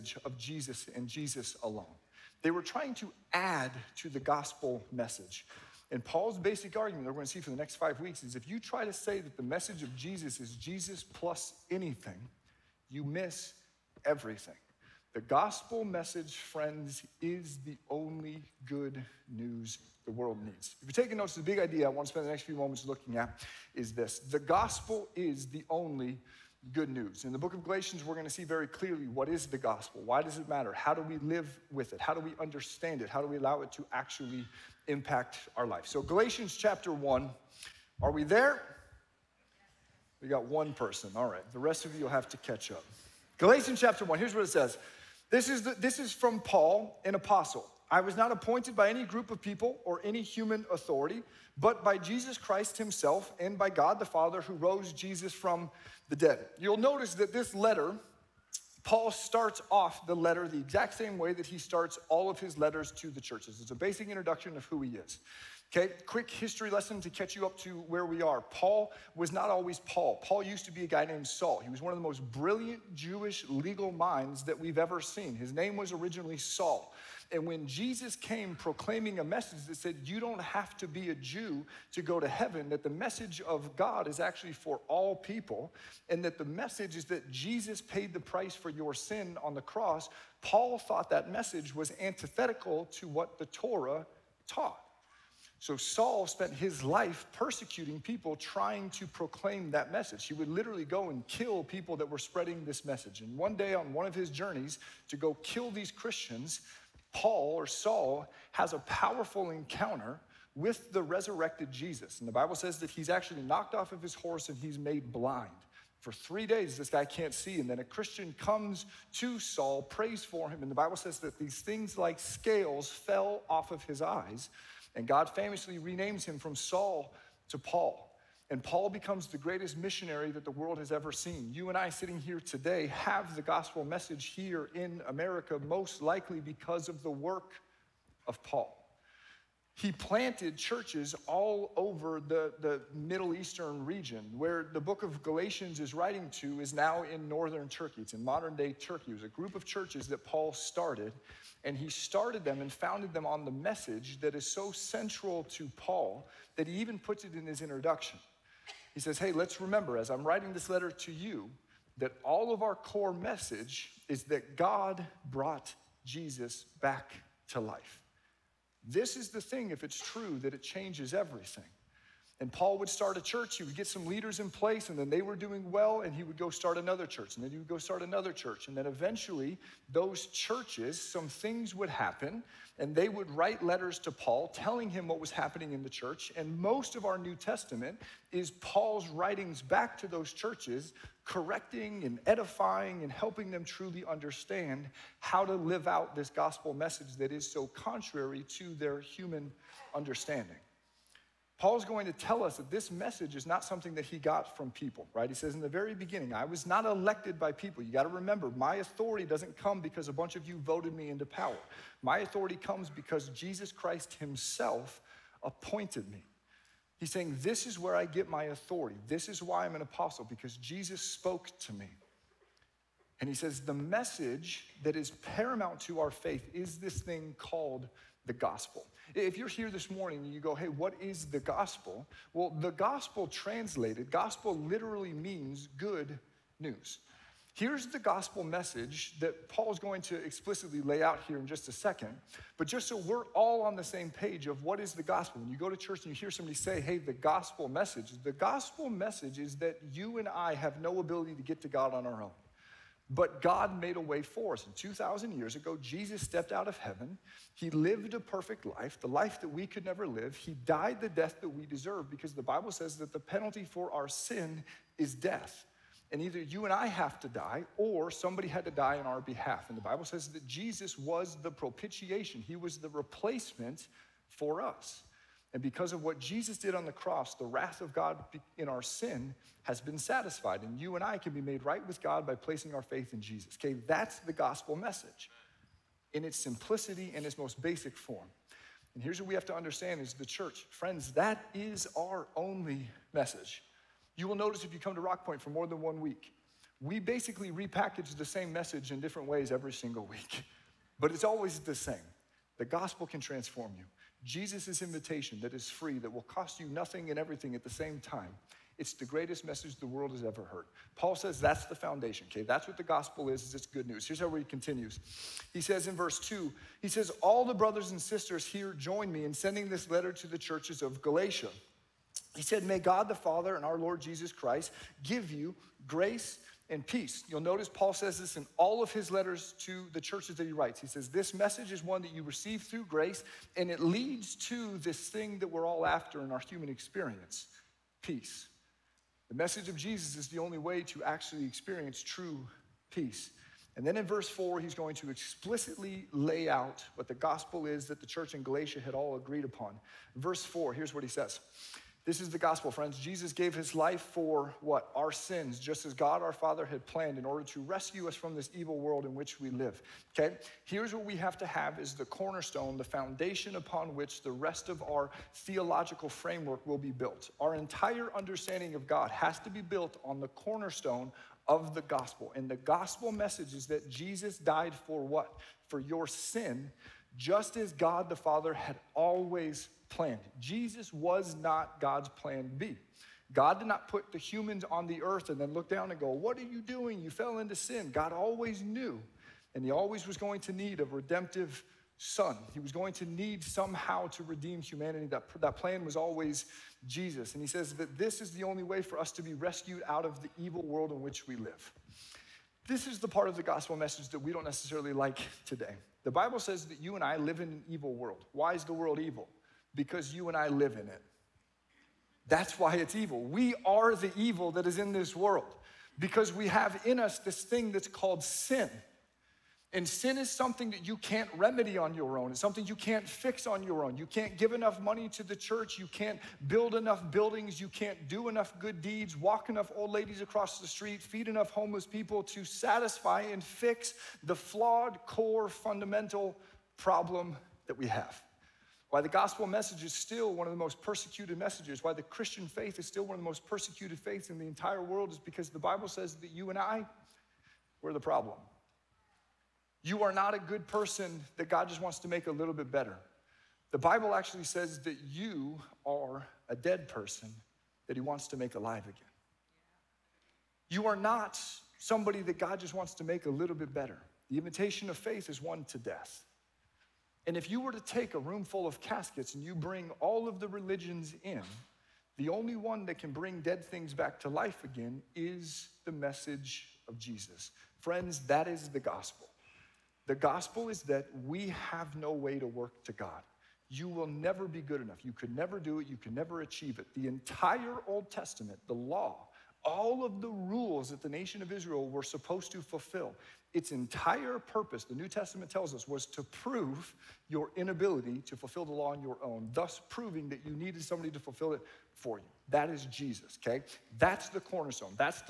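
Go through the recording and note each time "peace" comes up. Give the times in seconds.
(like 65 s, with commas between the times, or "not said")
326 s, 338 s, 342 s.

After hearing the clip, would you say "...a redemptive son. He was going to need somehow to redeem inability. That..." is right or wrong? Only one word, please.
wrong.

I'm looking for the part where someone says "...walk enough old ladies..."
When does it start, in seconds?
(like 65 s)
429 s.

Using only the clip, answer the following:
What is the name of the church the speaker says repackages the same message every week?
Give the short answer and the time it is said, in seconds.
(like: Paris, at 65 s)
Rock Point, at 294 s.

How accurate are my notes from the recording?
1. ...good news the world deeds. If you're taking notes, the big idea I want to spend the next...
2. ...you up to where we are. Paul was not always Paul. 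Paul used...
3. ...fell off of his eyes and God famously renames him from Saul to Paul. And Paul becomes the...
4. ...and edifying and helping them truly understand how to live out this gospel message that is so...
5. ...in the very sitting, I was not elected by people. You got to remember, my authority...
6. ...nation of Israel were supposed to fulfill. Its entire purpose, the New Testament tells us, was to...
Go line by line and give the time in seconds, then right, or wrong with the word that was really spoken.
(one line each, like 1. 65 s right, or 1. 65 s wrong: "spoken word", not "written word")
1. 18 s wrong: "needs", not "deeds"
2. 67 s right
3. 122 s right
4. 192 s right
5. 205 s wrong: "beginning", not "sitting"
6. 491 s right.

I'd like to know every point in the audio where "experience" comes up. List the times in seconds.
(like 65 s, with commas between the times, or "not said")
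336 s, 341 s.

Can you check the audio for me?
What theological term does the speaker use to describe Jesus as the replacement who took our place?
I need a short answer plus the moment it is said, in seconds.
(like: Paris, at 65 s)
Propitiation, at 271 s.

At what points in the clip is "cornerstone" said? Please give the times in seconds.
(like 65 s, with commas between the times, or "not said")
362 s, 370 s, 504 s.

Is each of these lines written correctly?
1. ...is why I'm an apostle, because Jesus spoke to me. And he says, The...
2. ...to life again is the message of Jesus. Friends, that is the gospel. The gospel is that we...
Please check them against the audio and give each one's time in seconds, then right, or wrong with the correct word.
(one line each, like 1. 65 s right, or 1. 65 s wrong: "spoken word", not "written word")
1. 219 s right
2. 474 s right.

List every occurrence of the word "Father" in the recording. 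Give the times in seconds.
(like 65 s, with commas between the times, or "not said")
54 s, 323 s, 356 s, 378 s.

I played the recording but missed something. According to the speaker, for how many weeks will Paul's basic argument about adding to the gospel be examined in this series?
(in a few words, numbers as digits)
5.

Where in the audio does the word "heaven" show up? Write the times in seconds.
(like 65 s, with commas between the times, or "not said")
82 s, 256 s.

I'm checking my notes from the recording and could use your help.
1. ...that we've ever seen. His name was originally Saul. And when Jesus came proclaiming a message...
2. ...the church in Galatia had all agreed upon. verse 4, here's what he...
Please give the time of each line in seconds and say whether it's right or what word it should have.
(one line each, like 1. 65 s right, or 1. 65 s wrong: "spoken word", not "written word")
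1. 74 s right
2. 347 s right.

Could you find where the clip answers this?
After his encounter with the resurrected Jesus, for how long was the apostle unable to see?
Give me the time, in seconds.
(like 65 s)
116 s.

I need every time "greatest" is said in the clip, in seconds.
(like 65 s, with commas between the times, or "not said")
129 s, 309 s.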